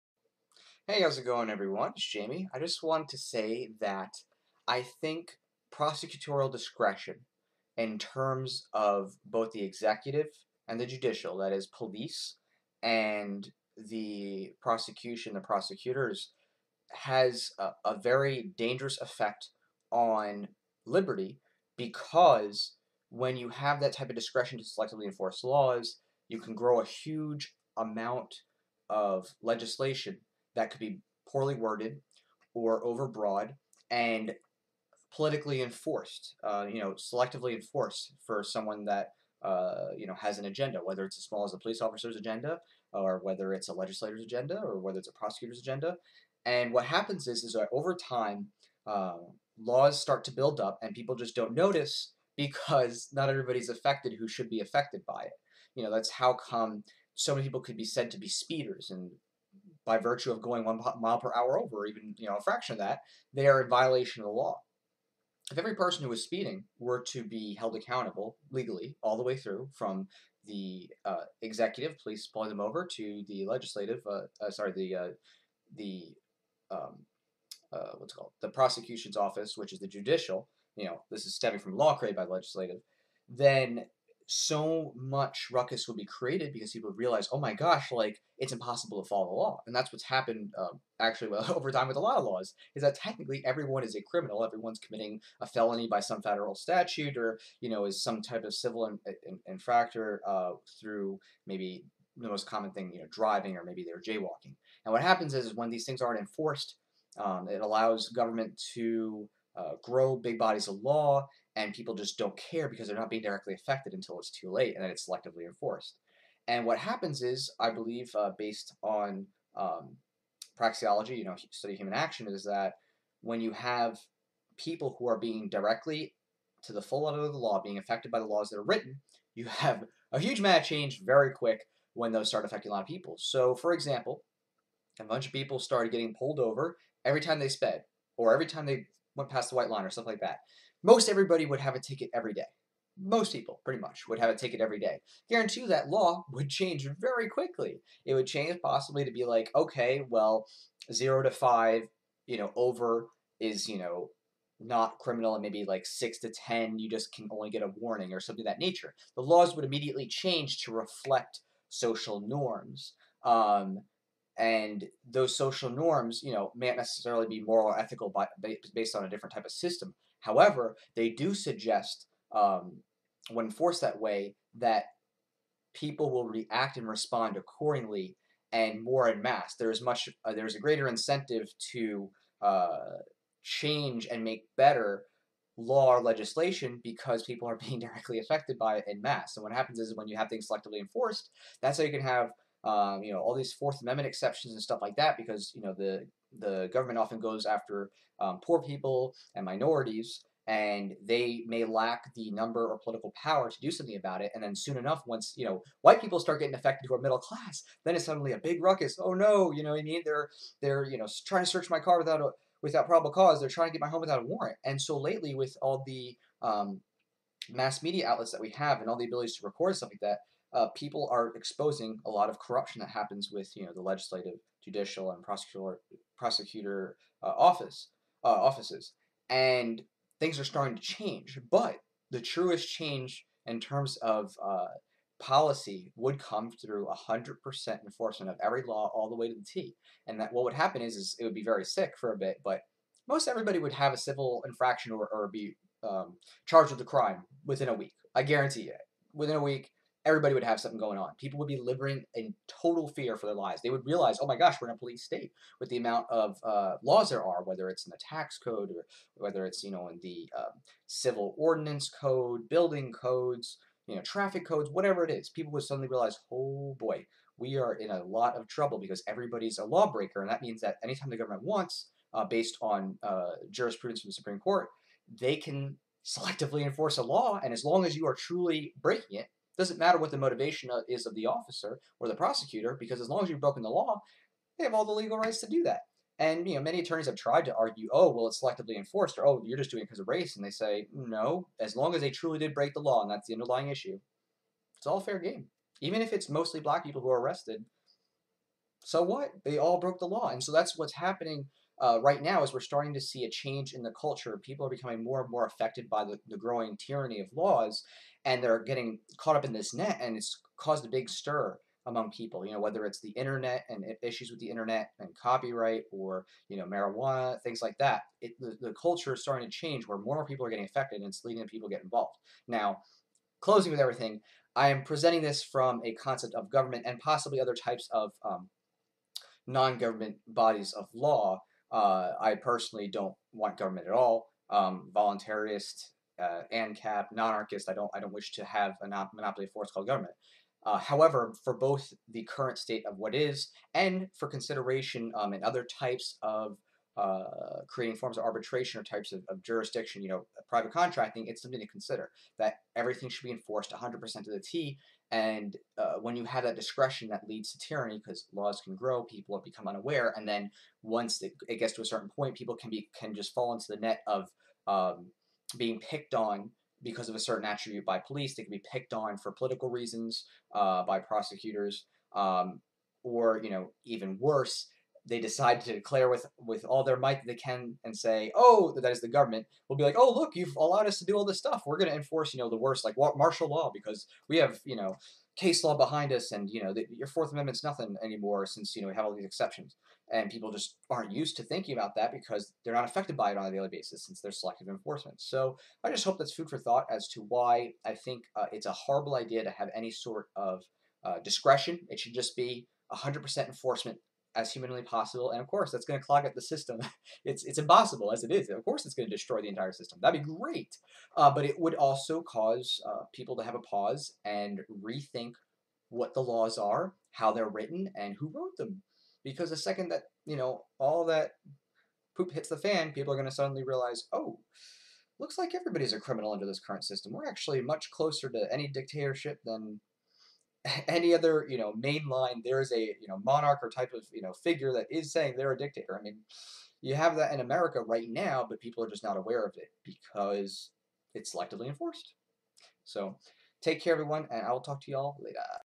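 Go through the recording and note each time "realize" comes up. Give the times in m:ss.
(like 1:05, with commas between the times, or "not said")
1:26, 4:13, 4:25, 7:03.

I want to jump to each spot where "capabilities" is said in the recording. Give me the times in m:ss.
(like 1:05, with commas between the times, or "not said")
not said.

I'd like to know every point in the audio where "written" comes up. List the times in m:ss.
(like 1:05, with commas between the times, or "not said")
2:08, 6:57.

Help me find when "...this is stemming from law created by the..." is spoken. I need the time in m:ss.
1:21.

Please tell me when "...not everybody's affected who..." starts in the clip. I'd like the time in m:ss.
0:53.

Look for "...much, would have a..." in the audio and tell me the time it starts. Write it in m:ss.
2:23.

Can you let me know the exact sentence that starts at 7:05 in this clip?
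Looks like everybody's a criminal under this current system.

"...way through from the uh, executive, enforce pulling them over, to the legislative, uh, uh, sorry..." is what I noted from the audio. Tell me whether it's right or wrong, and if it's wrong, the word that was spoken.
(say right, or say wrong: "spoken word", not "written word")
wrong: "police", not "enforce".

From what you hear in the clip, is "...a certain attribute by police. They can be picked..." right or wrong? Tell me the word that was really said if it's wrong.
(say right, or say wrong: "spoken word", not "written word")
right.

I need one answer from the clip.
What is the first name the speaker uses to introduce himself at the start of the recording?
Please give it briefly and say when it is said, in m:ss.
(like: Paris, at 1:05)
Jamie, at 0:02.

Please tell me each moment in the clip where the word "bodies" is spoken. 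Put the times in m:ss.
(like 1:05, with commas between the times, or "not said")
1:50, 5:30.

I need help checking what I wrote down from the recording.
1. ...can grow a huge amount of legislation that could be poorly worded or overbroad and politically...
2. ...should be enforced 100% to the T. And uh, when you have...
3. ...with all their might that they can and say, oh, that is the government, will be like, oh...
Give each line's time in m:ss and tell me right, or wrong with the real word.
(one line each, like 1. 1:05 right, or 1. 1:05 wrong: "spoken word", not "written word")
1. 0:26 right
2. 5:53 right
3. 6:16 right.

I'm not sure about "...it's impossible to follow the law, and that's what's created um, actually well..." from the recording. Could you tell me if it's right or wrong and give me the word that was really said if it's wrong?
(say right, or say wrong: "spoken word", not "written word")
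wrong: "happened", not "created".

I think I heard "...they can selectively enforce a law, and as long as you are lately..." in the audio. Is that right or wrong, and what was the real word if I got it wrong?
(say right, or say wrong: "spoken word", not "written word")
wrong: "truly", not "lately".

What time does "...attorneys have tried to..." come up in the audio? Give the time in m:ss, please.
4:46.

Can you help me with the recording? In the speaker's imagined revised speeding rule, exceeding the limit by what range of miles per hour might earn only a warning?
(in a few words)
6 to 10.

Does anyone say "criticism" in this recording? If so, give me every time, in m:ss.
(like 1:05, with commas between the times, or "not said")
not said.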